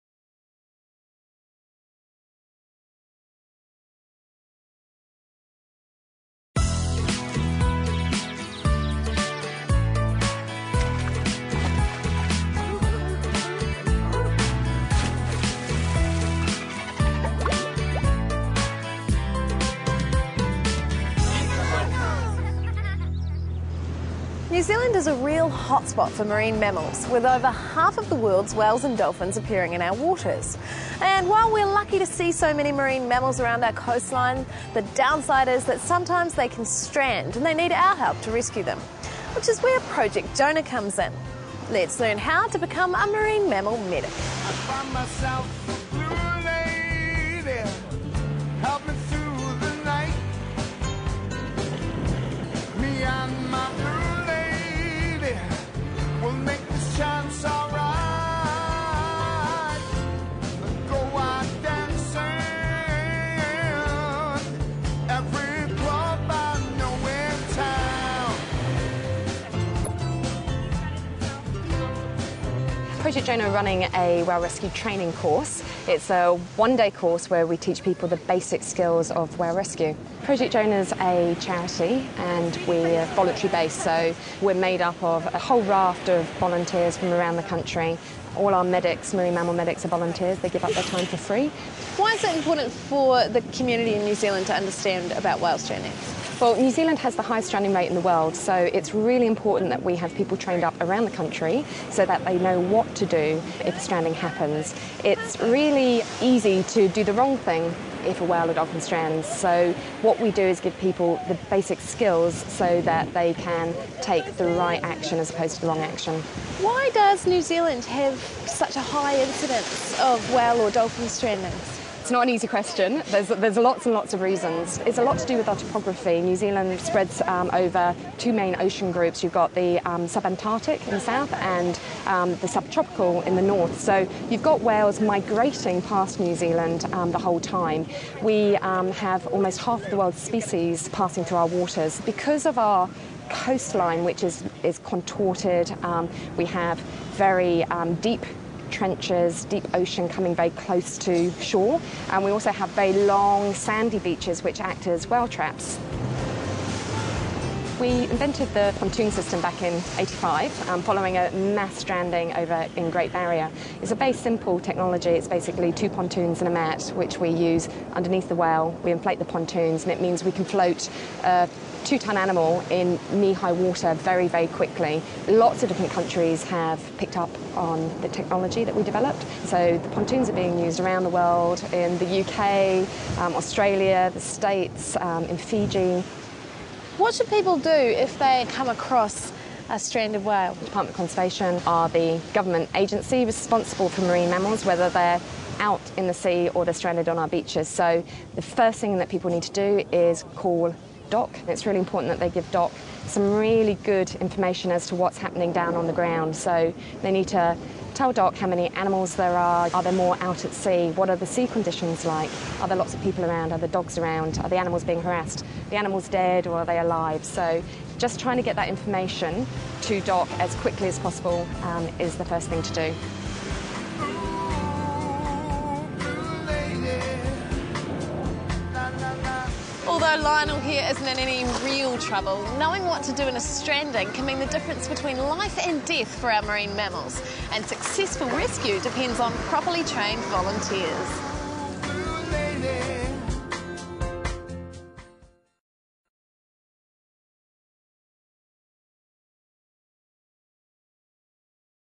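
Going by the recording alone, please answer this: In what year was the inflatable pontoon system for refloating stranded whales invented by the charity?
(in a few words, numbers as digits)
1985.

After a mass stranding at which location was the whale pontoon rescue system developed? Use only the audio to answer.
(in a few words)
Great Barrier.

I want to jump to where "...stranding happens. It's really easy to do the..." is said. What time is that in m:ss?
1:43.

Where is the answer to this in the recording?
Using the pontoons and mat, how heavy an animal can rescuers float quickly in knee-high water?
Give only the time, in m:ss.
2:51.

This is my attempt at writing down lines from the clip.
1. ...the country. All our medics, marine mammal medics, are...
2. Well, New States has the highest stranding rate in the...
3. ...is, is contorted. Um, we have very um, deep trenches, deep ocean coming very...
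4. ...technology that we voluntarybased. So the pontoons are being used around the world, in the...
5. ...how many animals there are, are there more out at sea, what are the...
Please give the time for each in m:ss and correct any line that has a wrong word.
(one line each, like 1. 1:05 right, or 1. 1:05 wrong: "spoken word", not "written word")
1. 1:27 right
2. 1:36 wrong: "Zealand", not "States"
3. 2:24 right
4. 2:58 wrong: "developed", not "voluntarybased"
5. 3:28 right.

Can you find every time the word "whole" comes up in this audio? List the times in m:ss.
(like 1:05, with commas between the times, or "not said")
1:25, 2:17.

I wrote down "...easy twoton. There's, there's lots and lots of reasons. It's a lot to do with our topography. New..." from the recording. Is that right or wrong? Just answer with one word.
wrong.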